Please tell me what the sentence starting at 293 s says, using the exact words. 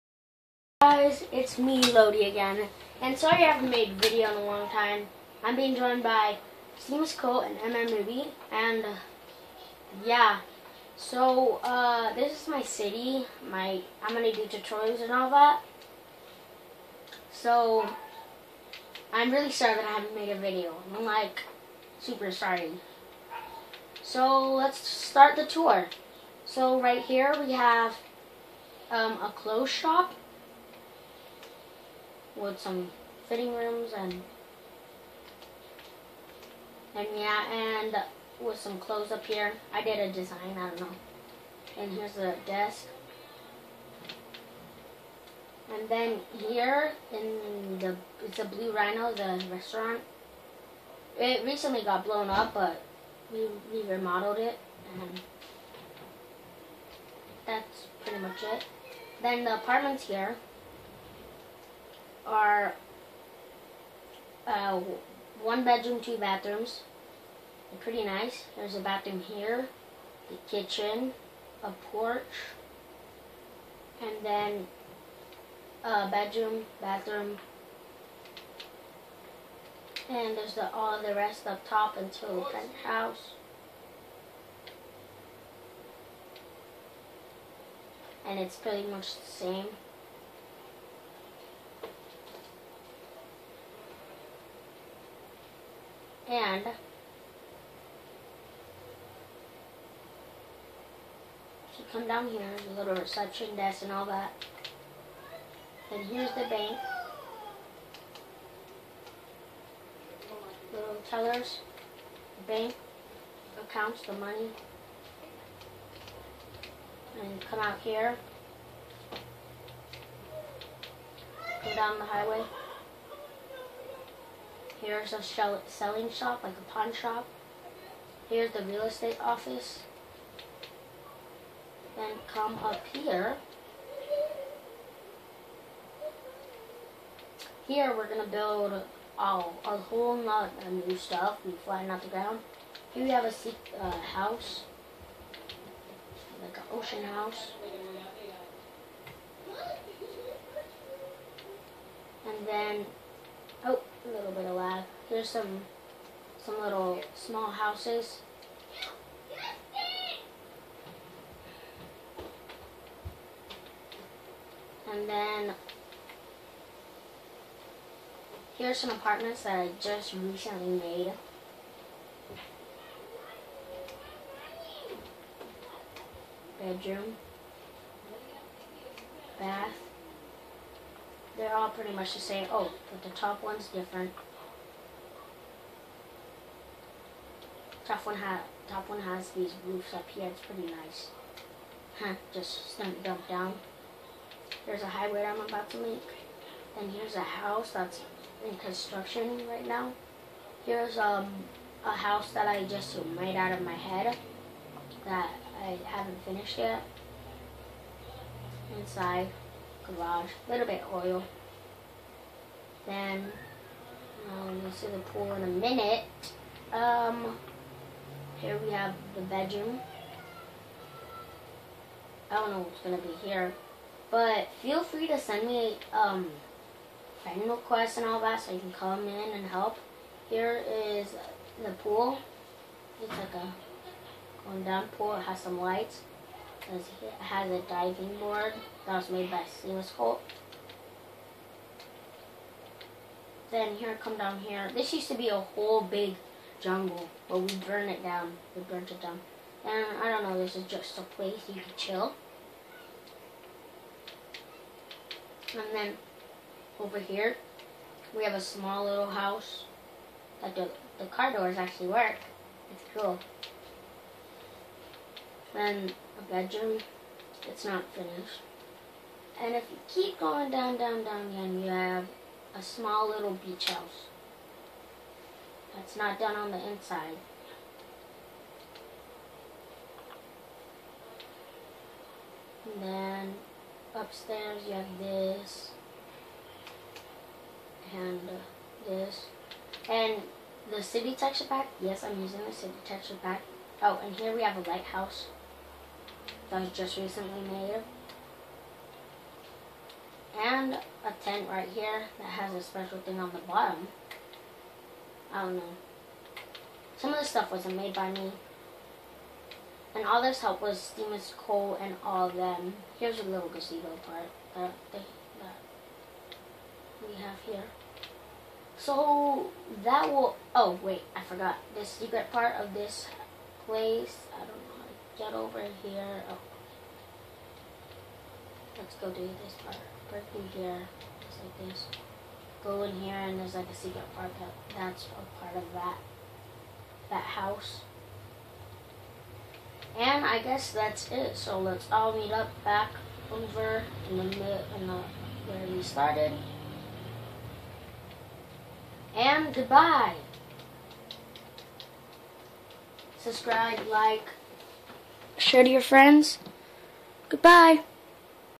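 Oh, and here we have a lighthouse that I just recently made.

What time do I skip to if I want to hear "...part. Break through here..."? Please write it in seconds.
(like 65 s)
329 s.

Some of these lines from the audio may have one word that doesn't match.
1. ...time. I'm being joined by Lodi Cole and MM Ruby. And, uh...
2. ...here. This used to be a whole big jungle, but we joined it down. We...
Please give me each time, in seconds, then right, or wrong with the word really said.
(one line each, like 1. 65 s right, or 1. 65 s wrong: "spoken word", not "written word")
1. 4 s wrong: "Seamus", not "Lodi"
2. 244 s wrong: "burned", not "joined".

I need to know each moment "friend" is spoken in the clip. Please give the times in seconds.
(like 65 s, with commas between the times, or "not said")
227 s, 355 s.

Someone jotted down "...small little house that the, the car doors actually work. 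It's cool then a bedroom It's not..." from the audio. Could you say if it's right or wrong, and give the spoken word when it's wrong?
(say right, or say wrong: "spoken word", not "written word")
right.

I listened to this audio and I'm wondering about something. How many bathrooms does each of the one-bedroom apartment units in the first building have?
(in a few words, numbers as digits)
2.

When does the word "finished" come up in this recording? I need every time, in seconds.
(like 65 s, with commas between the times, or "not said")
206 s, 267 s.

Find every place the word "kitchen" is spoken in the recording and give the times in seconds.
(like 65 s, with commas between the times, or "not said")
70 s.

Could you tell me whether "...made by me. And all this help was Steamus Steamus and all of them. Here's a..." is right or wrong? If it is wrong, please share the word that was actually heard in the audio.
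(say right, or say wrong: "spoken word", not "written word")
wrong: "Cole", not "Steamus".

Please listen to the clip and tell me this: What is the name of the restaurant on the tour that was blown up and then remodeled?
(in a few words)
Blue Rhino.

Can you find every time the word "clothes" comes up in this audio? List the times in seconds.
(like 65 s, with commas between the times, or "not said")
29 s, 38 s.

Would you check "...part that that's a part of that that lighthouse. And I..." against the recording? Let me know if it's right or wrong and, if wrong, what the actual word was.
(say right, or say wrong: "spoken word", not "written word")
wrong: "house", not "lighthouse".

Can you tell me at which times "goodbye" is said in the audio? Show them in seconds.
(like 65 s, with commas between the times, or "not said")
349 s, 357 s.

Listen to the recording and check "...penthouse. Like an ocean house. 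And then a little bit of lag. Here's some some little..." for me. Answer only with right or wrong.
wrong.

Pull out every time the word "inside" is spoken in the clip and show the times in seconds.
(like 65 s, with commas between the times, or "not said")
208 s, 276 s.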